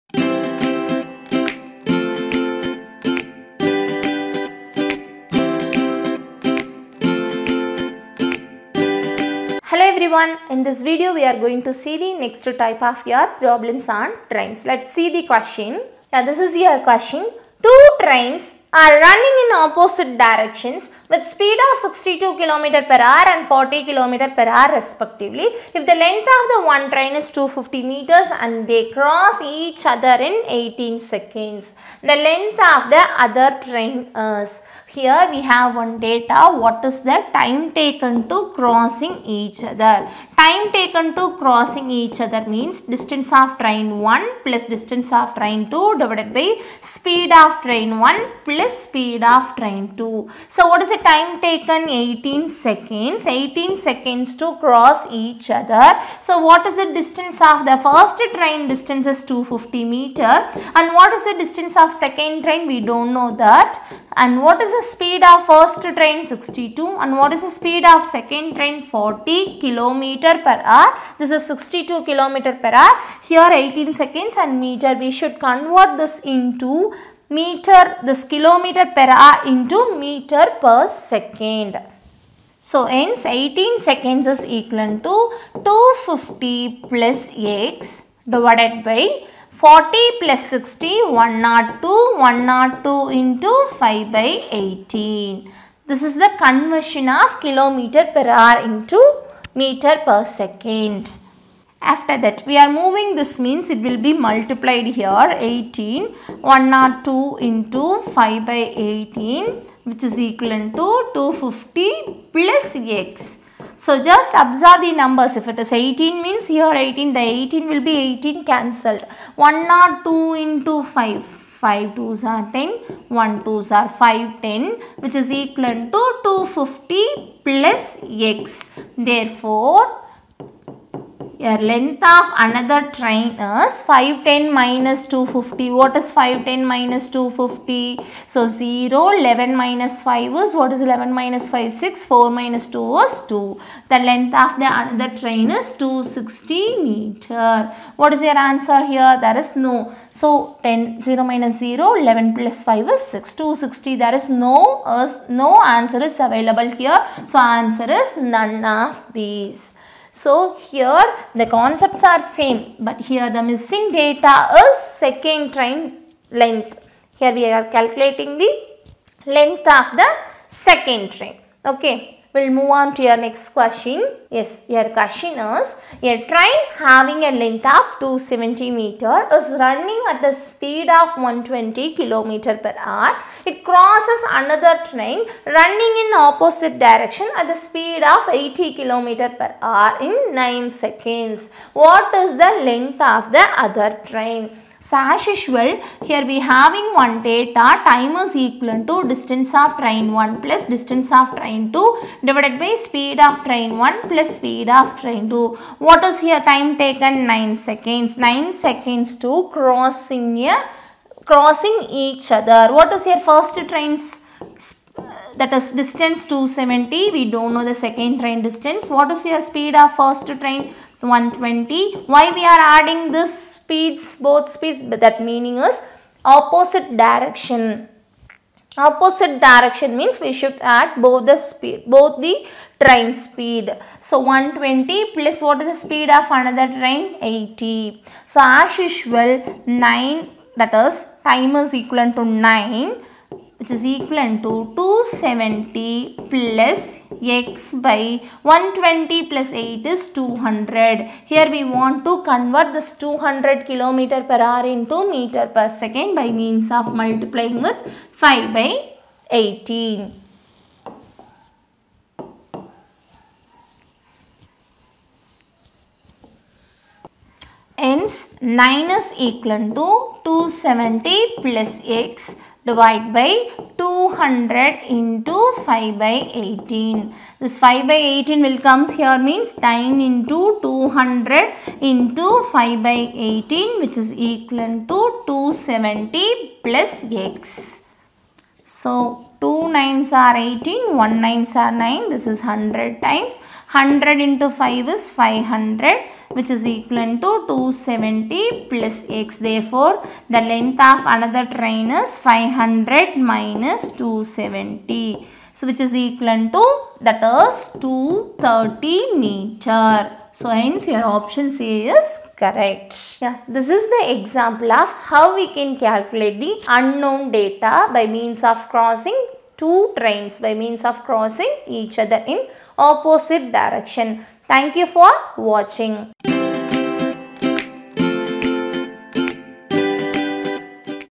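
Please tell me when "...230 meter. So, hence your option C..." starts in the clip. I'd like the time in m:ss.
5:07.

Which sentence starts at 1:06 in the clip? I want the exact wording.
62 and what is the speed of second train?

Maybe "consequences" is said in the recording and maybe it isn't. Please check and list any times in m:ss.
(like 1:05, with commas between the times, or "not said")
not said.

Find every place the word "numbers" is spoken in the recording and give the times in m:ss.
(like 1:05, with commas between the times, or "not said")
1:54.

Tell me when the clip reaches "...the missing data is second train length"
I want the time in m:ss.
2:43.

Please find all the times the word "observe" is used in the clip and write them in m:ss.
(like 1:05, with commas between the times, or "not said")
1:54.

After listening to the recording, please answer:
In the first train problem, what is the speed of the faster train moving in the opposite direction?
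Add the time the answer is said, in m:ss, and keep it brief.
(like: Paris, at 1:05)
62 km per hour, at 0:21.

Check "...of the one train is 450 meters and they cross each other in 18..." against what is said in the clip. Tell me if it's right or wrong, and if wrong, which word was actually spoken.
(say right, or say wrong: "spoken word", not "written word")
wrong: "250", not "450".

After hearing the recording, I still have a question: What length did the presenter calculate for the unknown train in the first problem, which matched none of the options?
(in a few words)
260 meters.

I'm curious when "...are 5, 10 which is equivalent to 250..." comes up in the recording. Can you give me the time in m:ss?
2:03.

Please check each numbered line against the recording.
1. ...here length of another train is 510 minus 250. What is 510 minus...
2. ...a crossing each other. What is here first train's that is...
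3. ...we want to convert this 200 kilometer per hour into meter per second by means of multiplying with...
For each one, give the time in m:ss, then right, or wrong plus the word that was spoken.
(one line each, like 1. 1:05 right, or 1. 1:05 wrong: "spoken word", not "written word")
1. 2:11 right
2. 3:30 right
3. 4:11 right.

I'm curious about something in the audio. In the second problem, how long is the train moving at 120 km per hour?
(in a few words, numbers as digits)
270 meters.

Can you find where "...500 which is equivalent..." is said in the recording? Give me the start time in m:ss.
4:55.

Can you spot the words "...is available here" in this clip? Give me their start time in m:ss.
2:36.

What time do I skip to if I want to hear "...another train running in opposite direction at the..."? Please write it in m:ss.
3:04.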